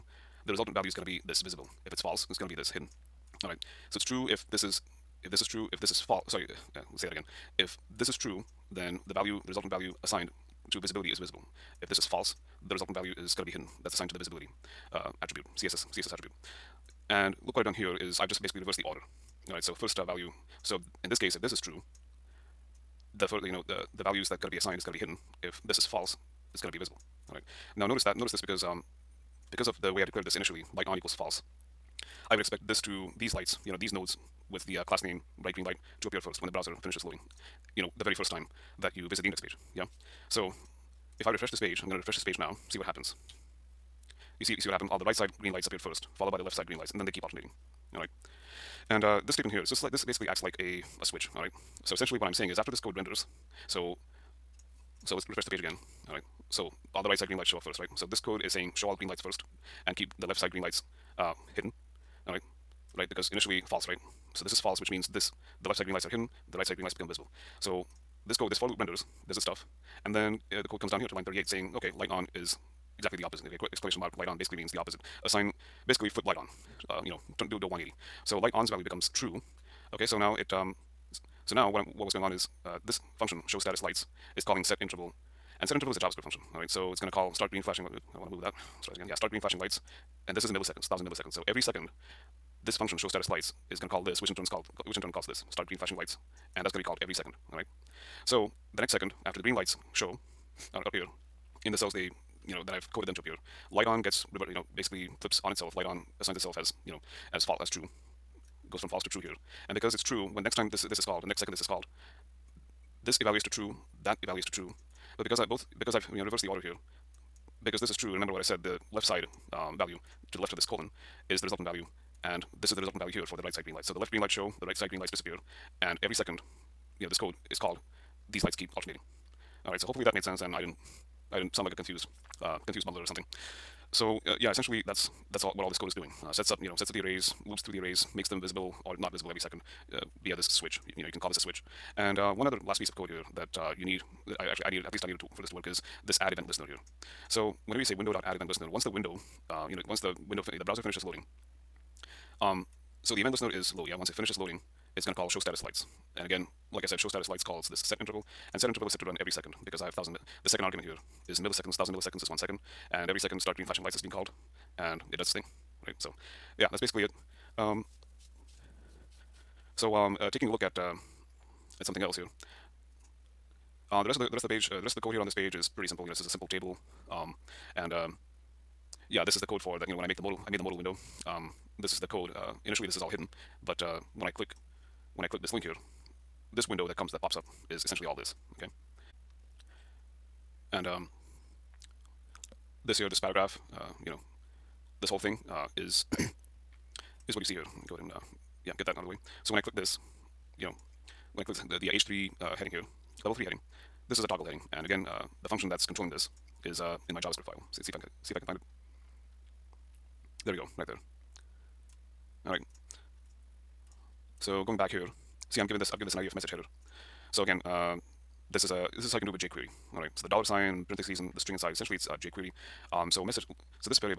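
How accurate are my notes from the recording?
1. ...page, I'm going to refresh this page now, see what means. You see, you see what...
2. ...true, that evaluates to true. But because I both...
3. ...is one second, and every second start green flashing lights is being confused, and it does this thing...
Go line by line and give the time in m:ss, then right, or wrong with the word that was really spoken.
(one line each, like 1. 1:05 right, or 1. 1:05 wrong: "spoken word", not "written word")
1. 0:41 wrong: "happens", not "means"
2. 1:53 right
3. 2:42 wrong: "called", not "confused".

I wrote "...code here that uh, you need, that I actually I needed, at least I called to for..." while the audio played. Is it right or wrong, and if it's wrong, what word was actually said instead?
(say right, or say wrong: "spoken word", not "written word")
wrong: "needed", not "called".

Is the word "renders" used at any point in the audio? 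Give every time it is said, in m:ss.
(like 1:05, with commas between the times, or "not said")
0:52, 1:08.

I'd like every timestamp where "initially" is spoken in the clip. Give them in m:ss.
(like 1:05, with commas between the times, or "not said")
0:30, 1:03, 3:02.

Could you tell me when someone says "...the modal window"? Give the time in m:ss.
3:00.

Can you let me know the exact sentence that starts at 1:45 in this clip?
Light on assigns itself as you know, as false as true.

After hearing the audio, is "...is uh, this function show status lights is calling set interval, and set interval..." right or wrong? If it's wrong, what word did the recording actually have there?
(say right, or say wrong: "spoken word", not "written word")
right.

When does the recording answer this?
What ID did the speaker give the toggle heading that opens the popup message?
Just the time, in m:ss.
3:36.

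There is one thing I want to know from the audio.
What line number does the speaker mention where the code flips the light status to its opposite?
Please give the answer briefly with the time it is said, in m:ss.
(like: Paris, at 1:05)
38, at 1:11.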